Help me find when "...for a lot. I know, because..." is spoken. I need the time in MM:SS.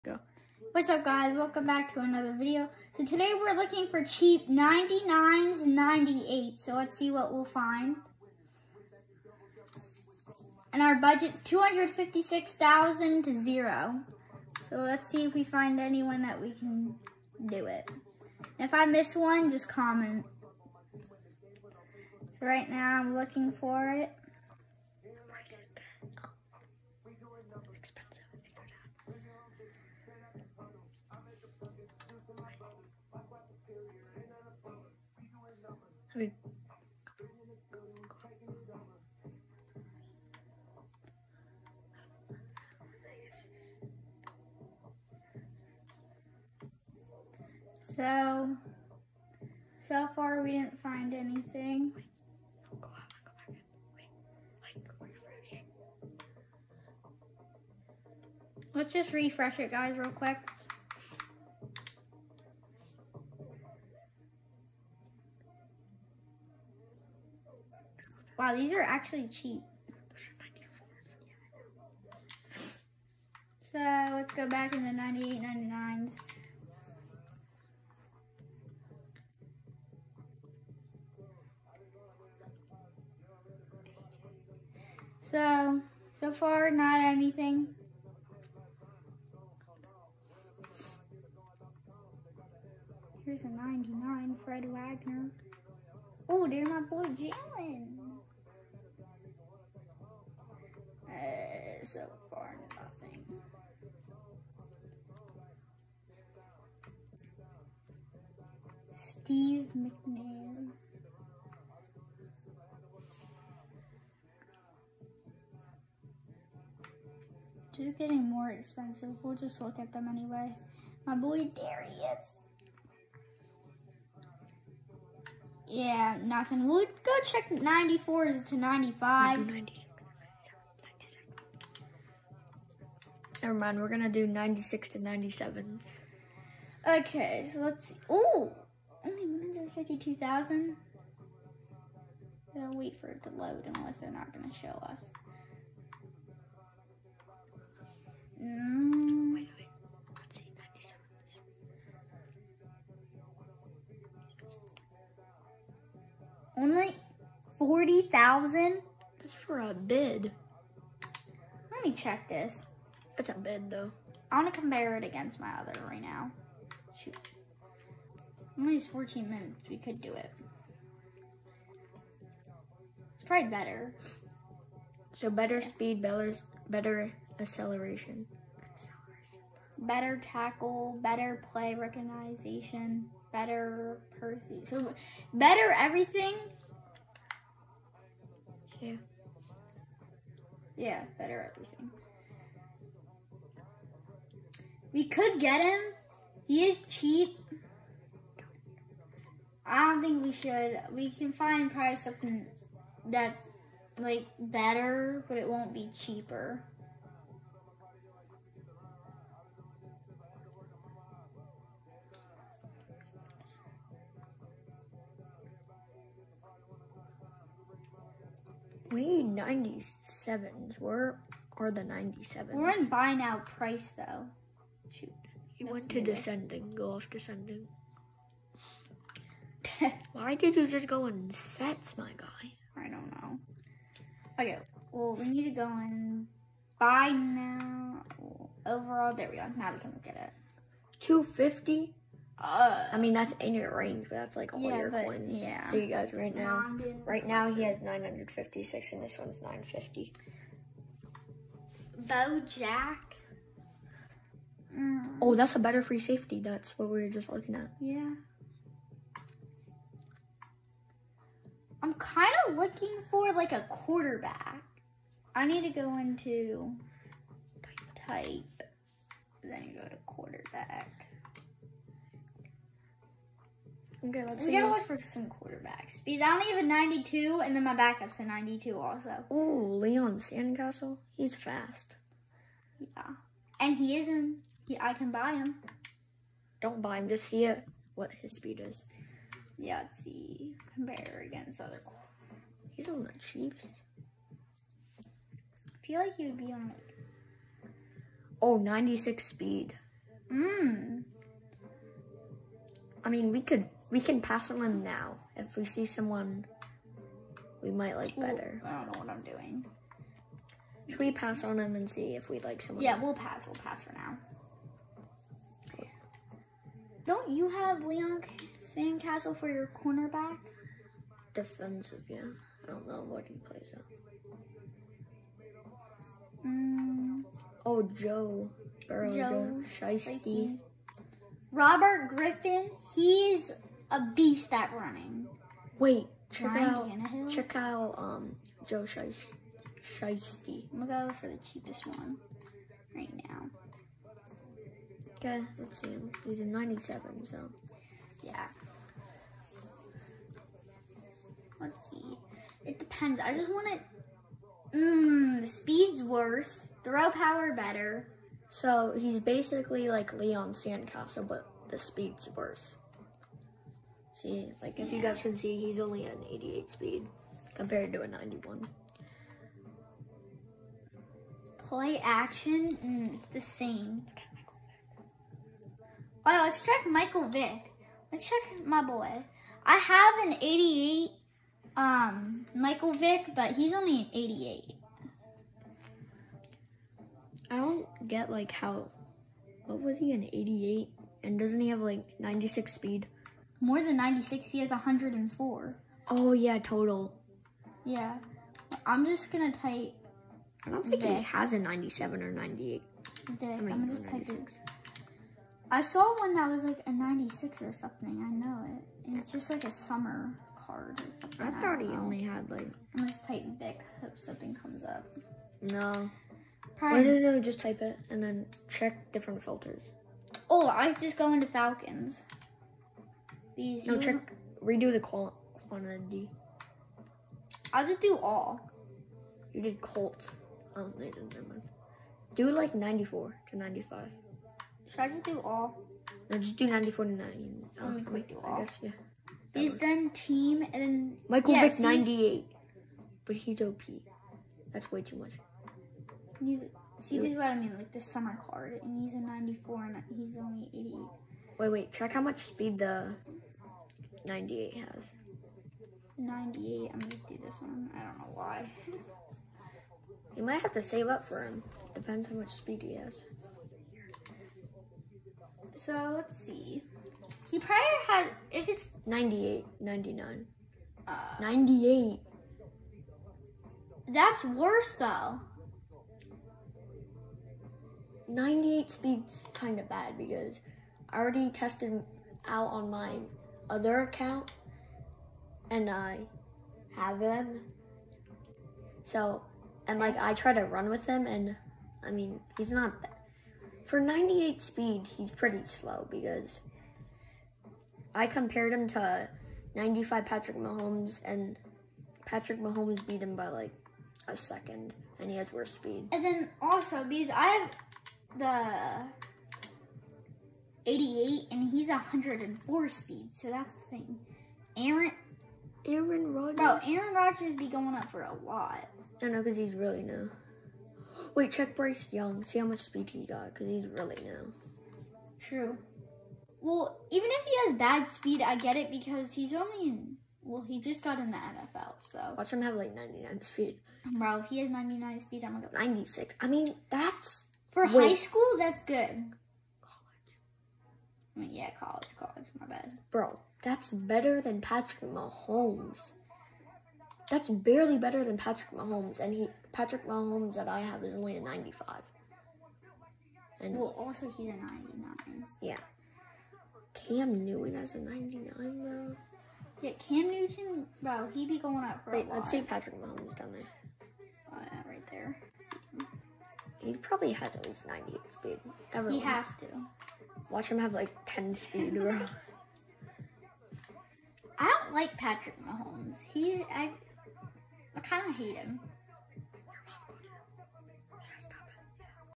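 08:38.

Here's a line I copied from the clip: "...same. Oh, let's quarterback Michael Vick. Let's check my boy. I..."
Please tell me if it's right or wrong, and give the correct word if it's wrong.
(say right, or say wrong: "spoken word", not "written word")
wrong: "check", not "quarterback".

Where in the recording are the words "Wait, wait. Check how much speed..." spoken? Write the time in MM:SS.
07:31.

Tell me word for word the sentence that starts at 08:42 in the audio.
See how much speed he got, because he's really now.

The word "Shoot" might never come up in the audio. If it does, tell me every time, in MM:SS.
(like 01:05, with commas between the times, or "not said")
02:47, 03:44.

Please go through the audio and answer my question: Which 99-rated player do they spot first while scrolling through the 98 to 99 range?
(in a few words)
Fred Warner.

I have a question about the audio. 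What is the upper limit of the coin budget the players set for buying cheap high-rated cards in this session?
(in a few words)
256,000.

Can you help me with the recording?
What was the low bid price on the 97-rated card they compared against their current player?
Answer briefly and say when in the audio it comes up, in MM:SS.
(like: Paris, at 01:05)
40,000, at 02:37.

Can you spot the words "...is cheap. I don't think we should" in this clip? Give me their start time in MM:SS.
03:16.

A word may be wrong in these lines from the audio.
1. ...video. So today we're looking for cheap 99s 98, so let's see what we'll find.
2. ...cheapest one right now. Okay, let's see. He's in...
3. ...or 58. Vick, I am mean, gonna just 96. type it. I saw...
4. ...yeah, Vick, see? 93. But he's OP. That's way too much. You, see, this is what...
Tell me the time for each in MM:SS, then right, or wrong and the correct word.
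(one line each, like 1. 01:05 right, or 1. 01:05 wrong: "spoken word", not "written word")
1. 00:02 right
2. 05:41 right
3. 06:42 wrong: "98", not "58"
4. 07:21 wrong: "98", not "93".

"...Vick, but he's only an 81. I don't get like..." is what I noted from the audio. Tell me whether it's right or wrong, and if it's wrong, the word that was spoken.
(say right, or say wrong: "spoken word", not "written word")
wrong: "88", not "81".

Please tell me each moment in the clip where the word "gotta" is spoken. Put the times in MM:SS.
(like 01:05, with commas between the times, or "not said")
02:22, 04:34.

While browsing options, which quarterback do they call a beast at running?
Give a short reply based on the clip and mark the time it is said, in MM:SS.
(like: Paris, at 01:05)
Robert Griffin, at 05:31.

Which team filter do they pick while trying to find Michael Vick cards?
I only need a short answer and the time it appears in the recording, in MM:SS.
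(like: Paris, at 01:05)
Falcons, at 07:01.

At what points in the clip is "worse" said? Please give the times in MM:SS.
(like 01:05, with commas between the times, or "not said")
05:56, 06:02, 07:54, 08:25.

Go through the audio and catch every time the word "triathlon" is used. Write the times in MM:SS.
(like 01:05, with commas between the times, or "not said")
not said.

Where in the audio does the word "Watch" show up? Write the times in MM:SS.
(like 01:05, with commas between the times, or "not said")
08:52, 09:30.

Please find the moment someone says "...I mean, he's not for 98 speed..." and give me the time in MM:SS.
08:12.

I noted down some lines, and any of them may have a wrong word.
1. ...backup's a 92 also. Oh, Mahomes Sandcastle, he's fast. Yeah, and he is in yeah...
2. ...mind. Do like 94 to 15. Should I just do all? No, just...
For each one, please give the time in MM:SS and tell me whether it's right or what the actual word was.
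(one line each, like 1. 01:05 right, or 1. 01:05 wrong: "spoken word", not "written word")
1. 04:37 wrong: "Leon", not "Mahomes"
2. 07:11 wrong: "95", not "15".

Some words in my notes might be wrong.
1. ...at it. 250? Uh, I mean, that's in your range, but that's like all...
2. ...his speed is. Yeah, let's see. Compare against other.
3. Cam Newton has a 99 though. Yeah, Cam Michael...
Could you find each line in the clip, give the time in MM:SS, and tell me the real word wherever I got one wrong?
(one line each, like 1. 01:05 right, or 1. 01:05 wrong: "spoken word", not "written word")
1. 04:00 right
2. 04:48 right
3. 09:17 wrong: "Newton", not "Michael".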